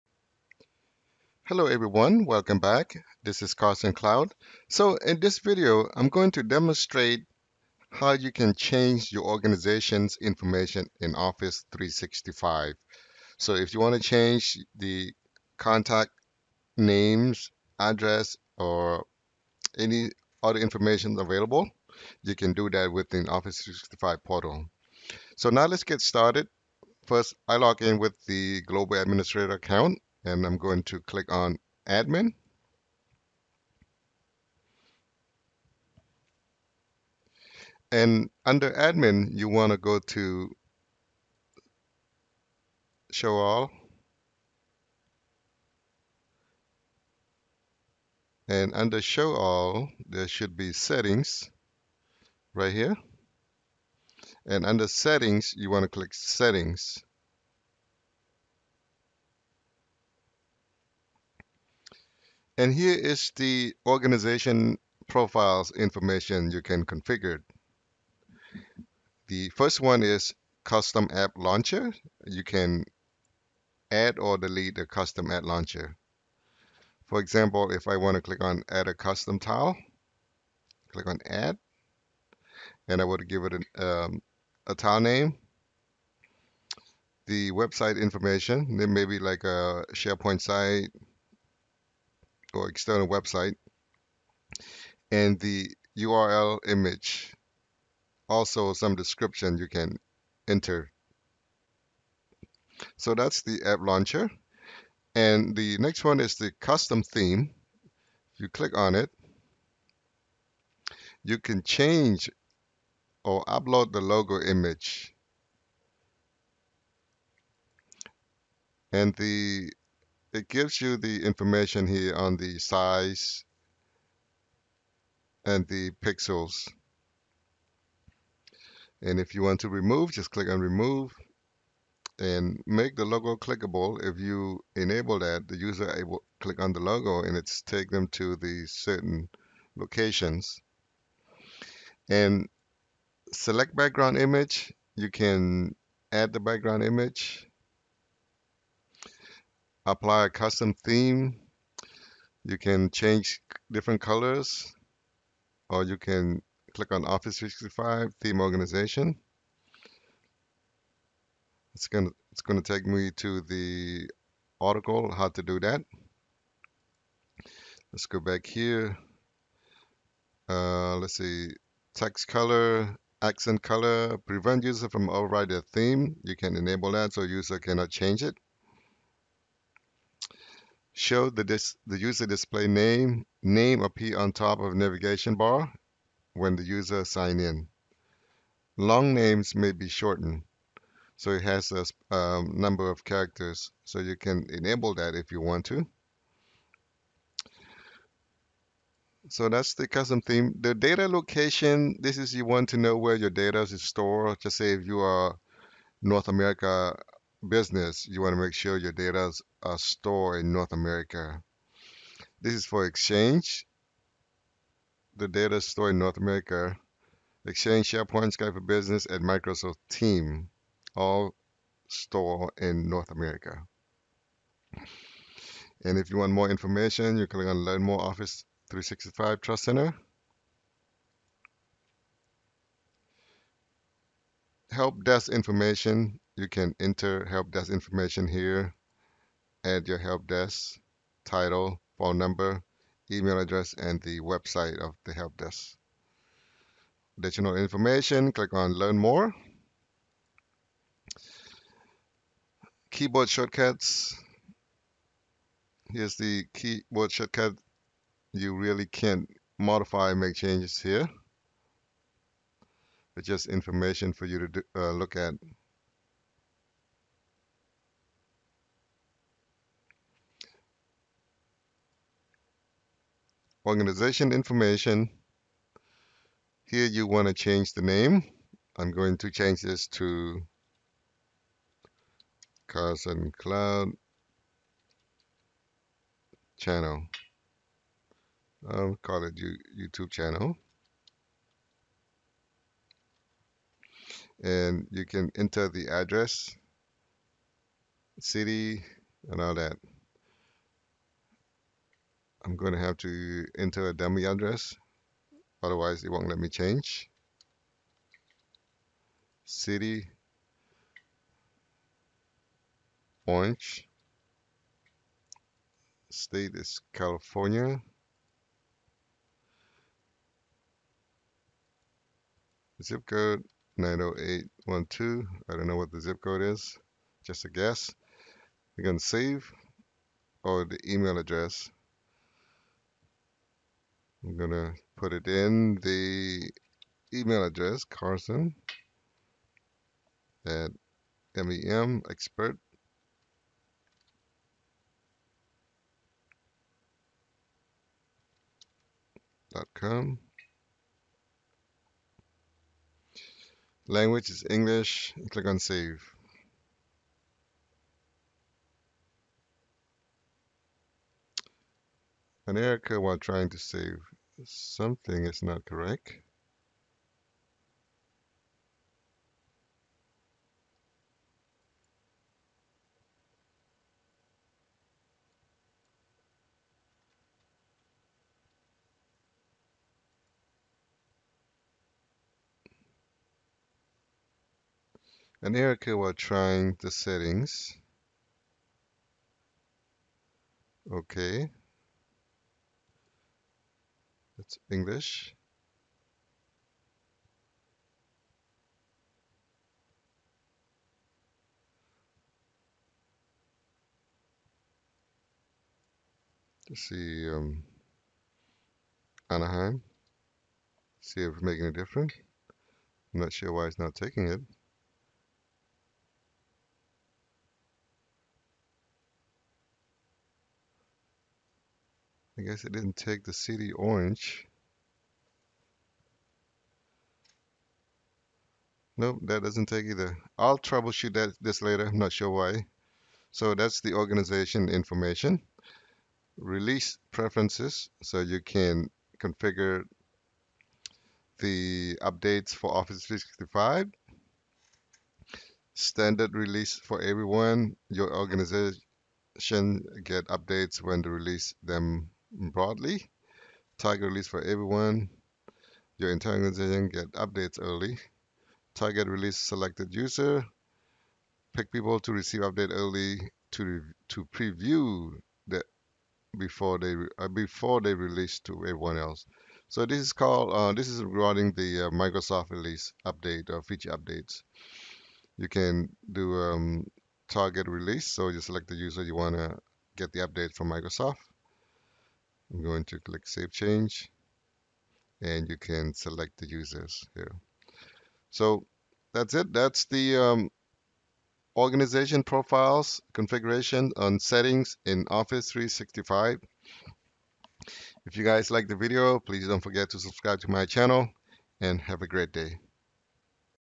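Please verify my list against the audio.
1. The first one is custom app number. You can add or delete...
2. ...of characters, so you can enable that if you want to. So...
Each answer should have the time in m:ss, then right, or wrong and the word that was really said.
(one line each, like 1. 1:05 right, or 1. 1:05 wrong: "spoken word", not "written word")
1. 1:09 wrong: "launcher", not "number"
2. 3:12 right.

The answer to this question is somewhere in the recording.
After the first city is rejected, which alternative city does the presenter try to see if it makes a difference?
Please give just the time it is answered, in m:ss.
6:49.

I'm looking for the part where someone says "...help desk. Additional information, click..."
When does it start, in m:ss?
4:05.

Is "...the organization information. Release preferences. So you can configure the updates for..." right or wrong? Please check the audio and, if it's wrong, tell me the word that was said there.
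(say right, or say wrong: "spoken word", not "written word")
right.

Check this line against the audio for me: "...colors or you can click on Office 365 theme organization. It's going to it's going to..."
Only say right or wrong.
right.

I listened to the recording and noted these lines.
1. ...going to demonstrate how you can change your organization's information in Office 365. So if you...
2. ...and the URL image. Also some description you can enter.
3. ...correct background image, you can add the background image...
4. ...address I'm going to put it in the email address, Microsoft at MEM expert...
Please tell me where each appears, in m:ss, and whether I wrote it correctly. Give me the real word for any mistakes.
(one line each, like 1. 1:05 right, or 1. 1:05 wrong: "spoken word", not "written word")
1. 0:06 right
2. 1:35 right
3. 2:23 wrong: "select", not "correct"
4. 5:31 wrong: "Carson", not "Microsoft".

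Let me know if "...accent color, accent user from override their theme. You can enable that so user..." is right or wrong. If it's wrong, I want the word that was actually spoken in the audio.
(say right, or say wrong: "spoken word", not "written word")
wrong: "prevent", not "accent".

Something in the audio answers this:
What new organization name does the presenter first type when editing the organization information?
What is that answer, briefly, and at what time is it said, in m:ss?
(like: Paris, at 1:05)
Carson Cloud channel, at 4:42.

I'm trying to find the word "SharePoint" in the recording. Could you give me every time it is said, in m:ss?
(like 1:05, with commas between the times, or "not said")
1:29, 3:37.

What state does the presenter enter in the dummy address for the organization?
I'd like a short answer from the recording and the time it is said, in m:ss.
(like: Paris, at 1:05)
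California, at 5:16.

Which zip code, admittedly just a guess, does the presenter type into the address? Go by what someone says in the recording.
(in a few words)
90812.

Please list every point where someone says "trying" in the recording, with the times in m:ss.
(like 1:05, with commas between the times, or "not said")
6:03, 6:26.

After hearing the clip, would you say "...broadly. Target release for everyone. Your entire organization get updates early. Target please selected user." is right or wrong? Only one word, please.
wrong.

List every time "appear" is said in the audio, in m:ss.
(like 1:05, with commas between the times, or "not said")
3:03.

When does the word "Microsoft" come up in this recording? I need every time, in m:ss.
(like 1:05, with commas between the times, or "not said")
3:39, 7:51, 8:00.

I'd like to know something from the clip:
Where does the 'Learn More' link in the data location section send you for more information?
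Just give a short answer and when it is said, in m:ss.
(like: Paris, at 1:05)
Office 365 Trust Center, at 3:48.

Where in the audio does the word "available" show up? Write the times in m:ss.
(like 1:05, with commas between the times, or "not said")
0:21.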